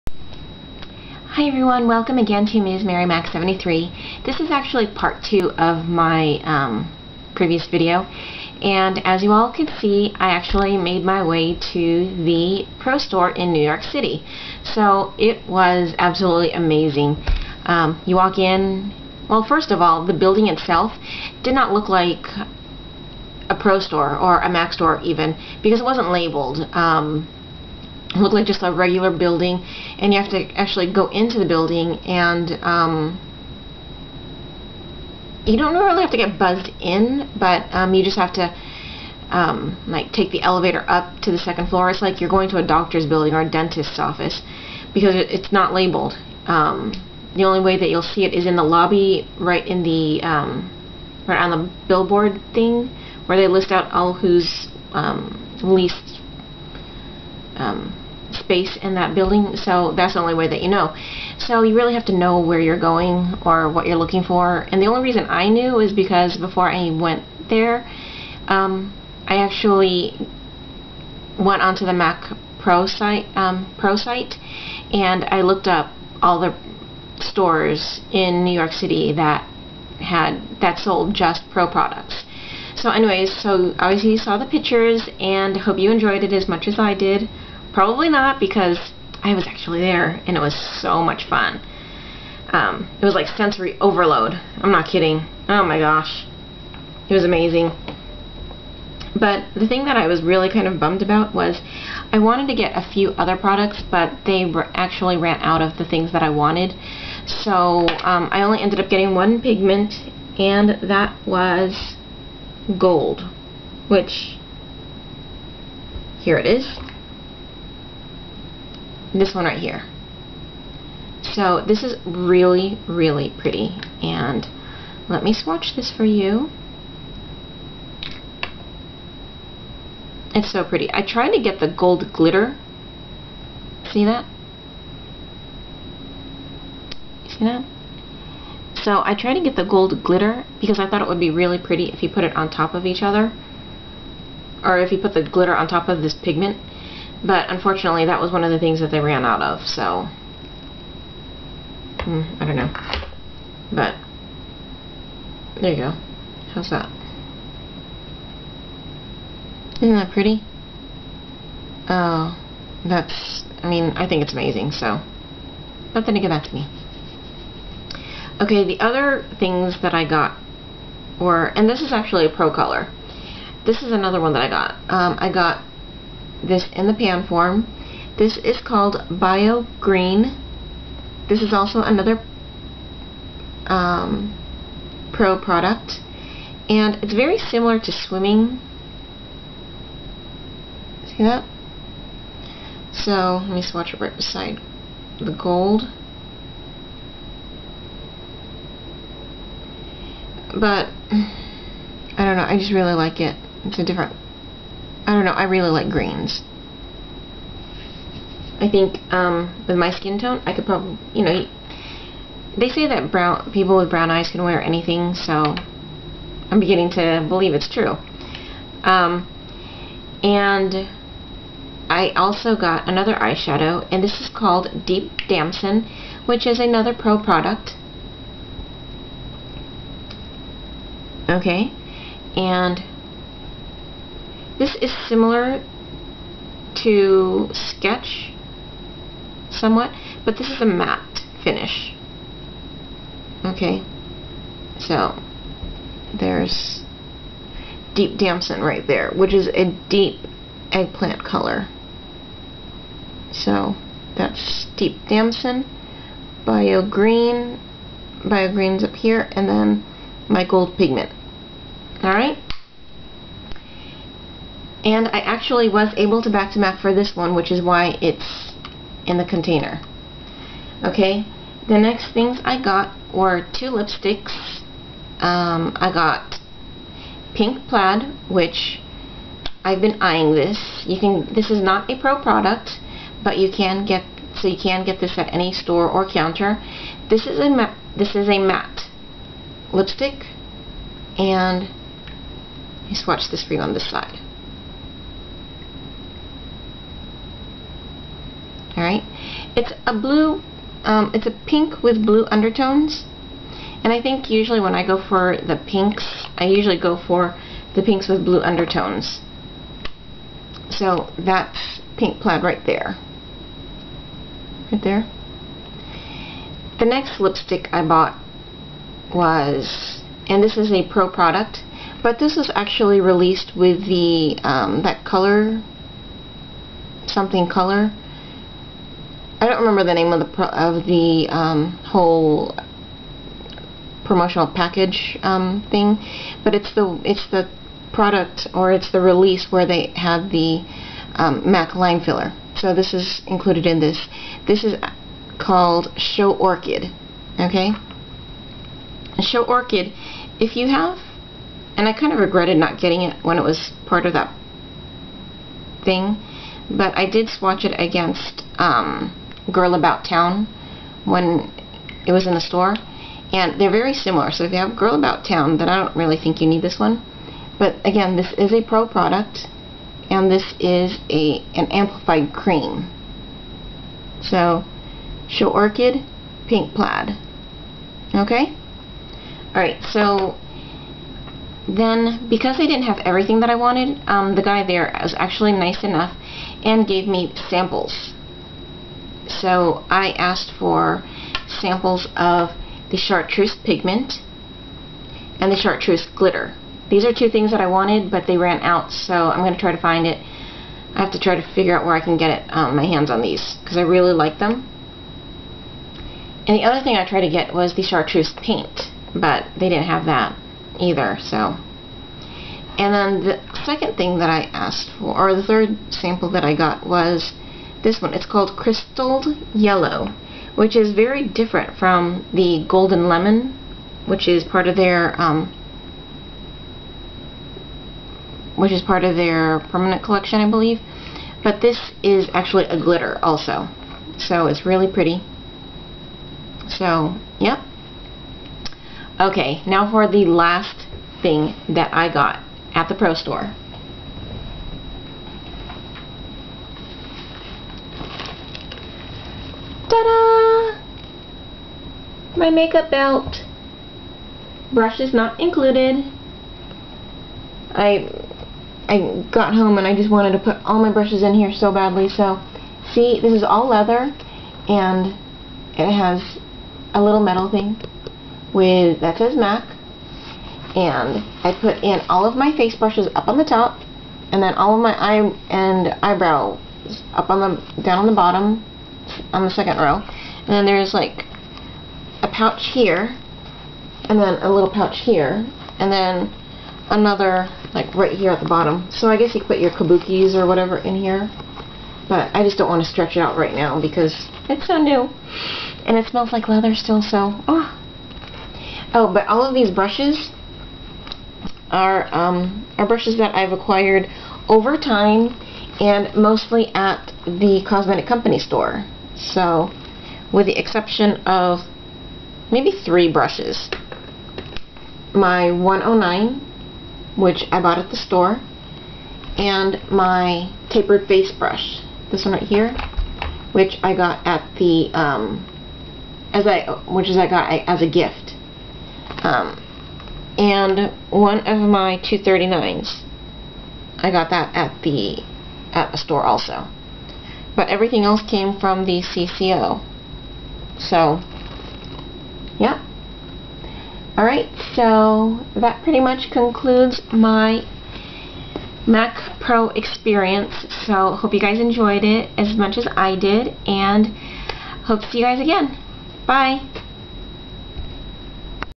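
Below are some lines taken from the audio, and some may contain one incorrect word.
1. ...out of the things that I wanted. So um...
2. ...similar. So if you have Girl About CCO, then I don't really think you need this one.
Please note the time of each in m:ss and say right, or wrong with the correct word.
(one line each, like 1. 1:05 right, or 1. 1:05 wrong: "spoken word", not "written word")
1. 1:45 right
2. 6:03 wrong: "Town", not "CCO".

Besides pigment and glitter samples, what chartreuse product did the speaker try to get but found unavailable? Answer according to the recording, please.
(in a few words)
chartreuse paint.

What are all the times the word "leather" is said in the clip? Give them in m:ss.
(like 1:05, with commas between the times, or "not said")
7:43, 8:16.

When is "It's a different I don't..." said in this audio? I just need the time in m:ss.
3:23.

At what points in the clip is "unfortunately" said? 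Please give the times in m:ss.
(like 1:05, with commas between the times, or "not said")
2:27.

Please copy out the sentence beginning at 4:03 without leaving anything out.
Okay, so there's deep damson right there, which is a deep eggplant color.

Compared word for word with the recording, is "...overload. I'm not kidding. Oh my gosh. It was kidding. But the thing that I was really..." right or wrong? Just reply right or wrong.
wrong.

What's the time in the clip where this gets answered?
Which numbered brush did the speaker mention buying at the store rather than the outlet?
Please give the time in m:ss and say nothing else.
8:35.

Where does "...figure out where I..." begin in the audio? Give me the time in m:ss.
6:41.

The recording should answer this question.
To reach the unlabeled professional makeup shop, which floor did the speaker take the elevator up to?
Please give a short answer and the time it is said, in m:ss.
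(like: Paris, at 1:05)
second floor, at 0:41.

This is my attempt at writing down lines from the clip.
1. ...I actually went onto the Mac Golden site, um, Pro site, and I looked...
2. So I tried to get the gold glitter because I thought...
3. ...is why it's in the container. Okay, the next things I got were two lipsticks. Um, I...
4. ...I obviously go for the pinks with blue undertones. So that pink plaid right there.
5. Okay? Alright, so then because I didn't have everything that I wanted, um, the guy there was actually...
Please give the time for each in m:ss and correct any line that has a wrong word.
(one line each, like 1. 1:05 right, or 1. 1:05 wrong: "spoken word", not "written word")
1. 1:09 wrong: "Pro", not "Golden"
2. 2:18 right
3. 4:27 right
4. 5:06 wrong: "usually", not "obviously"
5. 6:18 right.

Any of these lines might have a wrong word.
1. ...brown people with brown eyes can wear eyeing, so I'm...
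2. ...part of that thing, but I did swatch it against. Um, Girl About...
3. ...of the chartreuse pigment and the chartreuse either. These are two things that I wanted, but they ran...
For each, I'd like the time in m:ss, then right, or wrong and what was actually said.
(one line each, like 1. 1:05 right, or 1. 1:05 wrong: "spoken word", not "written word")
1. 3:33 wrong: "anything", not "eyeing"
2. 5:53 right
3. 6:32 wrong: "glitter", not "either".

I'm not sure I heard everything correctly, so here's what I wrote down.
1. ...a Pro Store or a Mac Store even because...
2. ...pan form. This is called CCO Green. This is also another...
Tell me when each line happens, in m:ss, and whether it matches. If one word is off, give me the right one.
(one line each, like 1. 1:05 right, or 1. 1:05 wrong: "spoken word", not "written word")
1. 0:23 right
2. 2:56 wrong: "Bio", not "CCO".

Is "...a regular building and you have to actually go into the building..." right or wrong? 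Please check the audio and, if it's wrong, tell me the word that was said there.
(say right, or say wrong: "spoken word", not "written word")
right.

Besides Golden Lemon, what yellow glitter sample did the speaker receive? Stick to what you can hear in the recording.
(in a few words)
Crystalled Yellow.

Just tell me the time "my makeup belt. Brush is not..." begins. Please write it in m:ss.
7:32.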